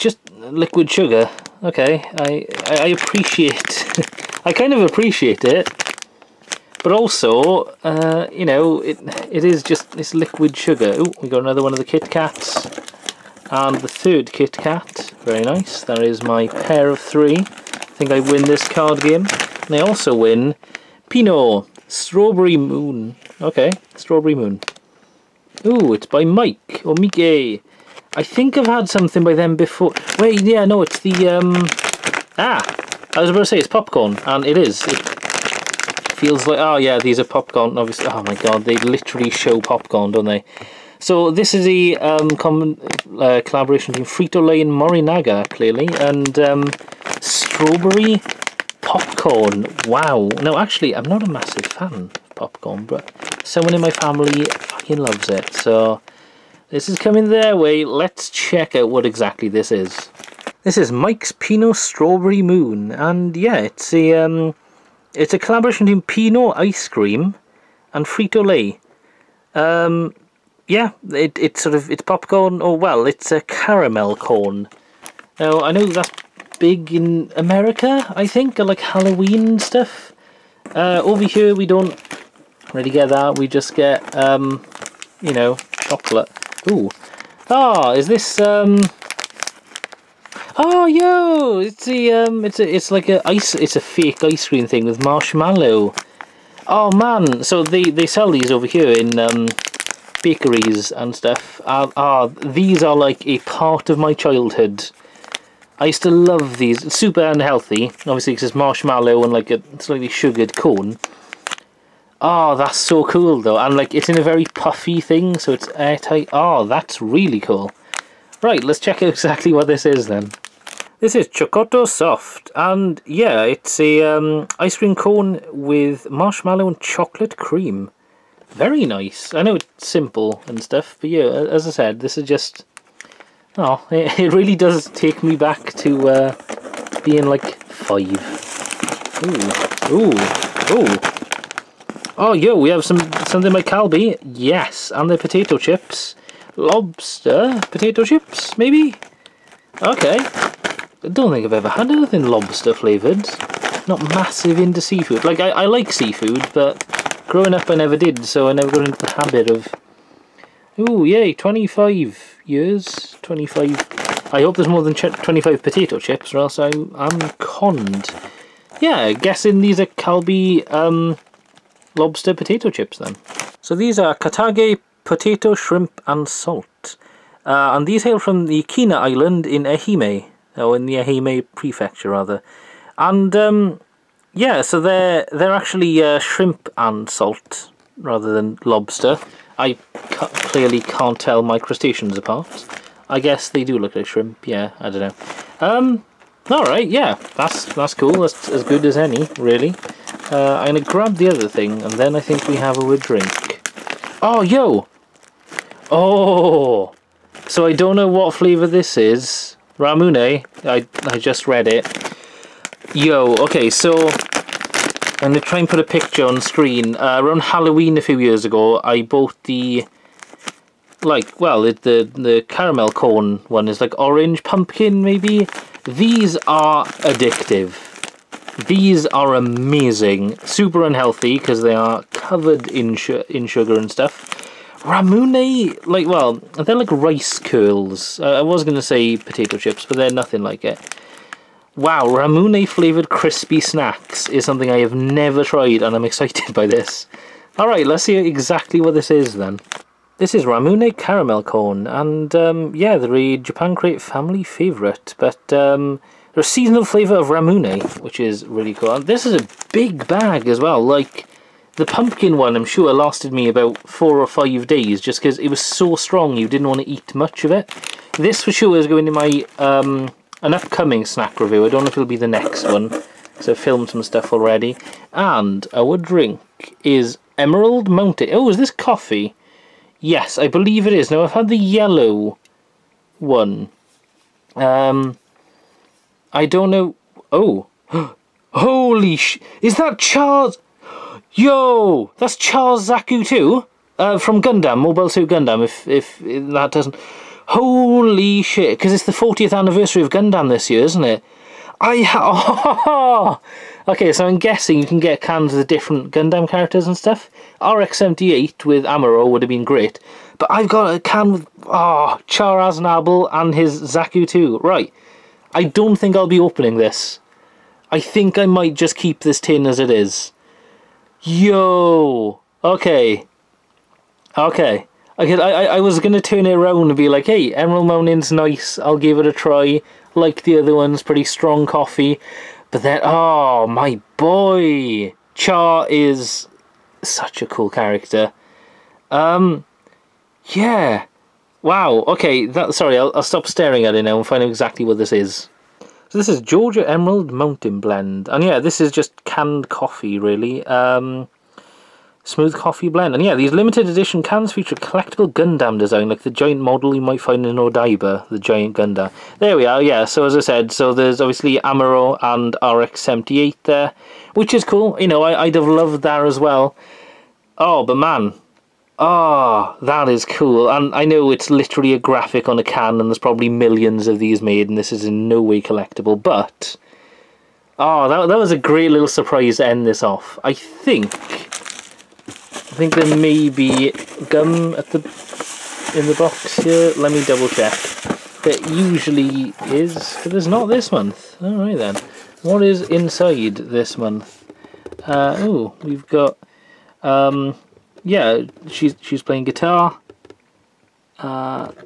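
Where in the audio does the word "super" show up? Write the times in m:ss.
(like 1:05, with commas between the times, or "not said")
1:46, 3:50.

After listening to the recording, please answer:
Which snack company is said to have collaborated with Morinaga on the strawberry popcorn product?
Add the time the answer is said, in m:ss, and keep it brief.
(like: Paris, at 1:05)
Frito-Lay, at 0:44.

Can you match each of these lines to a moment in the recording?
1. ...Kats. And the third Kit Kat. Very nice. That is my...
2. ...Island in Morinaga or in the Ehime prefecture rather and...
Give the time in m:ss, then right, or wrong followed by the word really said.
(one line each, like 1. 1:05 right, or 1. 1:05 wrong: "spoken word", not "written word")
1. 0:12 right
2. 2:58 wrong: "Ehime", not "Morinaga".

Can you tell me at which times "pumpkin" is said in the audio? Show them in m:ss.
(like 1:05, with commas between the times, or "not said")
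3:44, 4:21.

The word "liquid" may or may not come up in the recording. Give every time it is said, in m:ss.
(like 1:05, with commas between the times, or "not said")
0:00, 0:10.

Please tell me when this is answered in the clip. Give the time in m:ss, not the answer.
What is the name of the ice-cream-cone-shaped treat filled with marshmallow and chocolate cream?
2:01.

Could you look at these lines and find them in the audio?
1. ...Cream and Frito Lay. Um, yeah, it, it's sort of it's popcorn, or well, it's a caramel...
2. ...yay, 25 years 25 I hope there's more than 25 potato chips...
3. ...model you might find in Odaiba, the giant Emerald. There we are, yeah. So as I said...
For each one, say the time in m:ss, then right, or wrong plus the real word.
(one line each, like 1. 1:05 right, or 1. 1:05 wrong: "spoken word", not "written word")
1. 1:06 right
2. 2:41 right
3. 5:56 wrong: "Gundam", not "Emerald".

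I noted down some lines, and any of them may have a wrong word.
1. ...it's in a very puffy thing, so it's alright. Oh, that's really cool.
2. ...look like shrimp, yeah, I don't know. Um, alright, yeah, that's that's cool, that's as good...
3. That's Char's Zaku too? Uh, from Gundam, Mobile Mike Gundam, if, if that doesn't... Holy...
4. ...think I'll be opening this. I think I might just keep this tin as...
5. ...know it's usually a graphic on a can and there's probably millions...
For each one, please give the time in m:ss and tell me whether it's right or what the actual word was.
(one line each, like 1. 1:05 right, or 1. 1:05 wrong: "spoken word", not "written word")
1. 1:53 wrong: "airtight", not "alright"
2. 3:13 right
3. 4:52 wrong: "Suit", not "Mike"
4. 5:15 right
5. 6:11 wrong: "literally", not "usually".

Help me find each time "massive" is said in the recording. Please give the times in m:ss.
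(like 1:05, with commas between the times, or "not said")
0:51, 2:34.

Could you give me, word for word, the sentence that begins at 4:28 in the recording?
This for sure is going in my um, an upcoming snack review.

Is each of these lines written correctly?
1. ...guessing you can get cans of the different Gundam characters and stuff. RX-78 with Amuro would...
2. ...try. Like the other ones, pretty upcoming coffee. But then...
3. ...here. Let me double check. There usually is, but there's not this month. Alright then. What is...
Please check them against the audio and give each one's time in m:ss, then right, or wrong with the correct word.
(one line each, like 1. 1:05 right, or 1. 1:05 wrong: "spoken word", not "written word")
1. 5:04 right
2. 5:29 wrong: "strong", not "upcoming"
3. 6:26 right.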